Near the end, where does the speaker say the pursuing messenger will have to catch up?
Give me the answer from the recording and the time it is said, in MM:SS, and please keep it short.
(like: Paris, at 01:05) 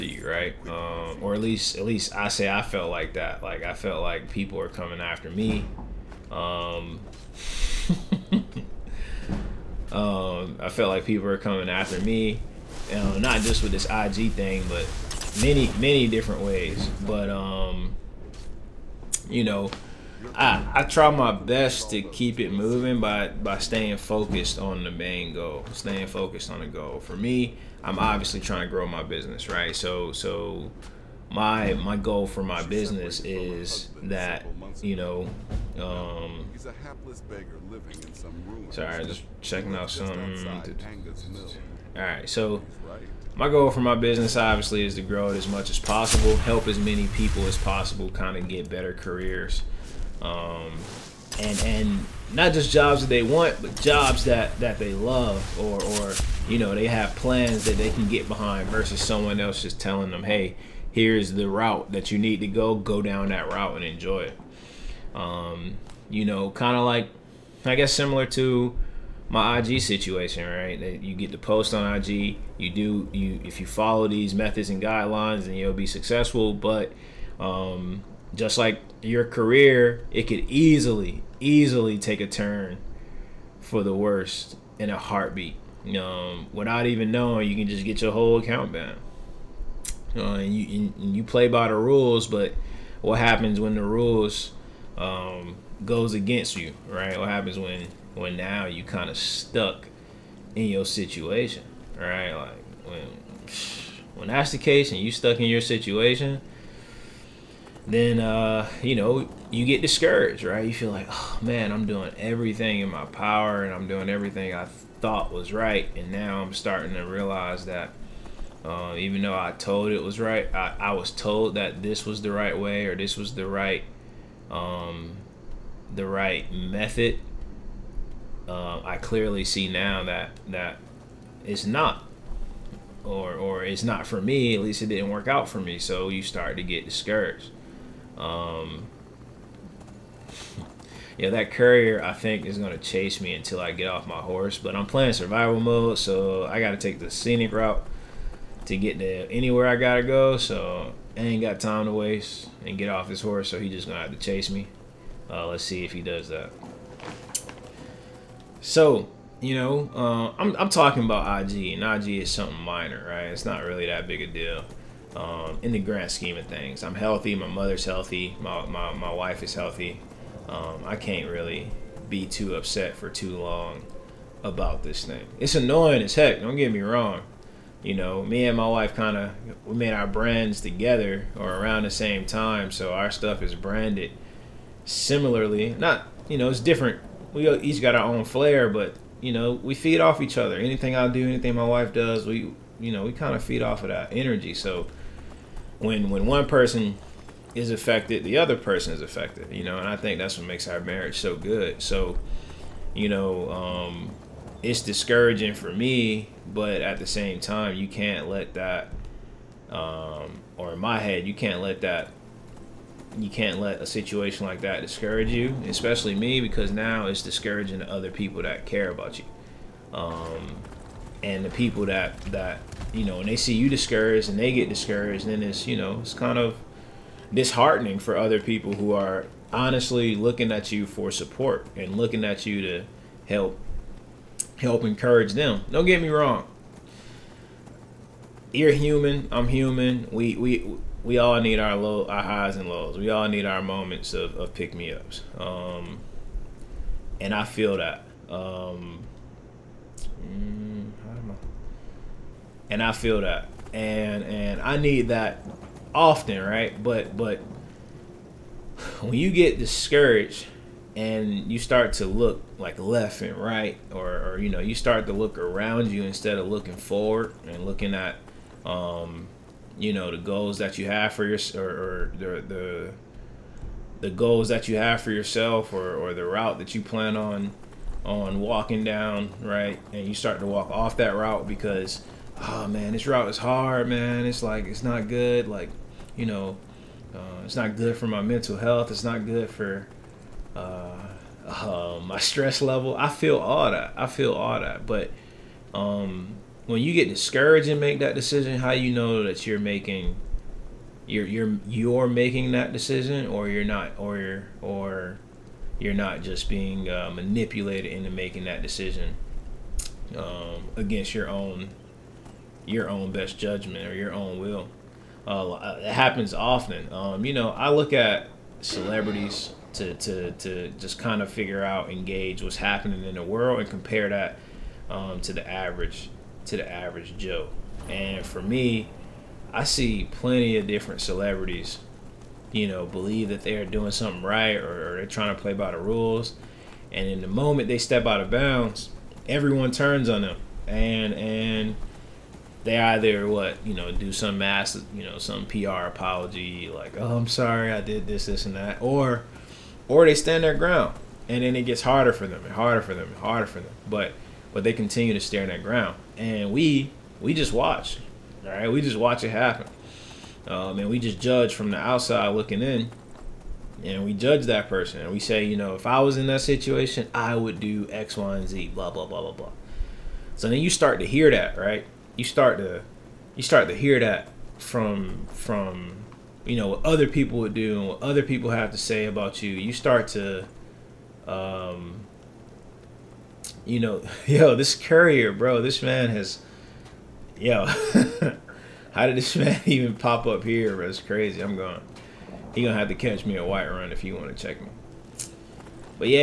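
Whiterun, at 06:33.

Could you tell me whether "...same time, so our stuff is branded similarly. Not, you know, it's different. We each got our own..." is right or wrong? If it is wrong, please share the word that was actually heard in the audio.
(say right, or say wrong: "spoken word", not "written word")
right.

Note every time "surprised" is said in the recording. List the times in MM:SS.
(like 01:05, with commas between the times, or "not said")
not said.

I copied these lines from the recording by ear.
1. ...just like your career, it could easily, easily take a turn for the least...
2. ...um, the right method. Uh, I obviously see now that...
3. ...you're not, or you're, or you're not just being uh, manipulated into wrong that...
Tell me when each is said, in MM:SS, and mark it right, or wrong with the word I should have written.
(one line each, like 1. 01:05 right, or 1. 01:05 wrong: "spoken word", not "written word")
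1. 01:18 wrong: "worst", not "least"
2. 02:04 wrong: "clearly", not "obviously"
3. 05:03 wrong: "making", not "wrong".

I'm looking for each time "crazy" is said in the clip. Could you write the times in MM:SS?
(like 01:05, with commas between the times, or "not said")
06:30.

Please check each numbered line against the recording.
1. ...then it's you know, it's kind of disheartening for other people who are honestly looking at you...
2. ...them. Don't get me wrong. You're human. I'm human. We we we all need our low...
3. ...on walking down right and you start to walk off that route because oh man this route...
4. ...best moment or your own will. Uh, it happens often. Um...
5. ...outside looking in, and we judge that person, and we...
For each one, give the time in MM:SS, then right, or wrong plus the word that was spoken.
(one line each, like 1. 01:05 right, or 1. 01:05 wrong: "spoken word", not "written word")
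1. 03:45 right
2. 03:55 right
3. 04:38 right
4. 05:13 wrong: "judgment", not "moment"
5. 06:01 right.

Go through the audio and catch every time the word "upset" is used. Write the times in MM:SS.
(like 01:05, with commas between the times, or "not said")
02:52.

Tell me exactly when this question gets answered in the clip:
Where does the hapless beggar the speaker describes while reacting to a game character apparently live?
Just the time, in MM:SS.
00:38.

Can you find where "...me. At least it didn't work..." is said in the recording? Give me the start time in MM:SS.
02:14.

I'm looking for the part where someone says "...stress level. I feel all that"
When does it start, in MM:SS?
04:52.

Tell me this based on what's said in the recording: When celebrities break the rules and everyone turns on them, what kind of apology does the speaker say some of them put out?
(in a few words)
PR apology.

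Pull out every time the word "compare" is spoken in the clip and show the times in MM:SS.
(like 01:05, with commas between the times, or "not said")
05:23.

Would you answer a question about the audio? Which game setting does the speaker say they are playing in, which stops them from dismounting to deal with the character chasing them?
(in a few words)
survival mode.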